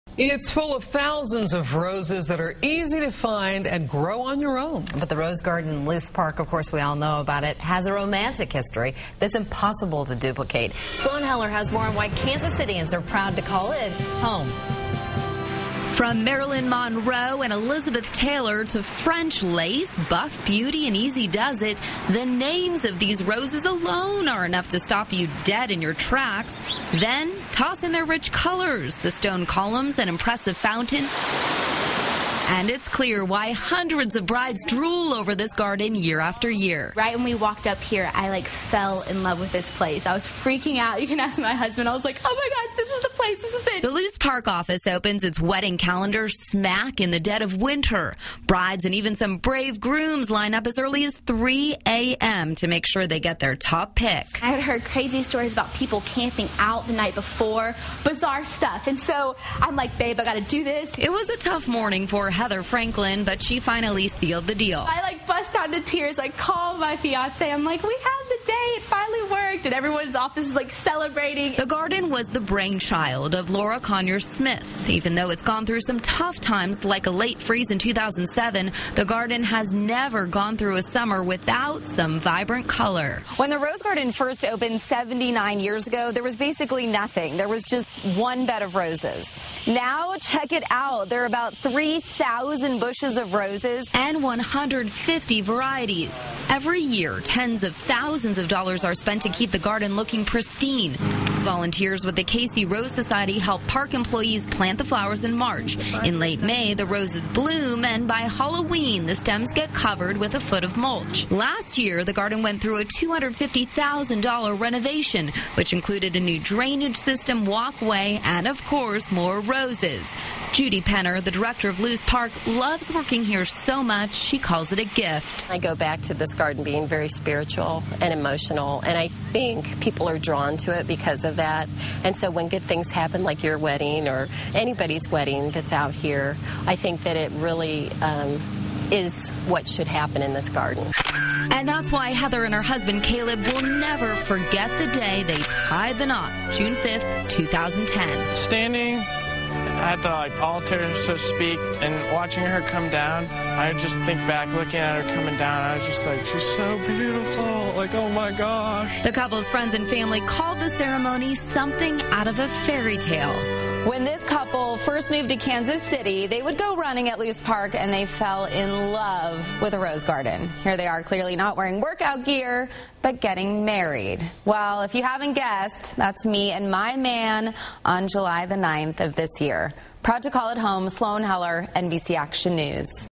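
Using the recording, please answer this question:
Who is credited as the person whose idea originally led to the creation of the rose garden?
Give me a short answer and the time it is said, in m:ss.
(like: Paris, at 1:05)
Laura Conyers Smith, at 1:13.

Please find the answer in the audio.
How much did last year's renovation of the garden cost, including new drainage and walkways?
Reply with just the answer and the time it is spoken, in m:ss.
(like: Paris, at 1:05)
$250,000, at 1:52.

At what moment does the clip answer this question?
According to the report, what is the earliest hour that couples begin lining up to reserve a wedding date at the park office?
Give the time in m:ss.
0:51.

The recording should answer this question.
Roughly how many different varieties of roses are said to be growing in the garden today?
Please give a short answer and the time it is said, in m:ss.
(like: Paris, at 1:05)
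150, at 1:34.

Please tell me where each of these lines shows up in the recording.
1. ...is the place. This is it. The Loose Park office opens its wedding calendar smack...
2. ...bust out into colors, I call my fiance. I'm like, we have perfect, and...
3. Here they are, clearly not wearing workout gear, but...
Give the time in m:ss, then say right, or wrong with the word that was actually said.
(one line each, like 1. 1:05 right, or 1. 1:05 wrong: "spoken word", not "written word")
1. 0:42 right
2. 1:05 wrong: "tears", not "colors"
3. 2:50 right.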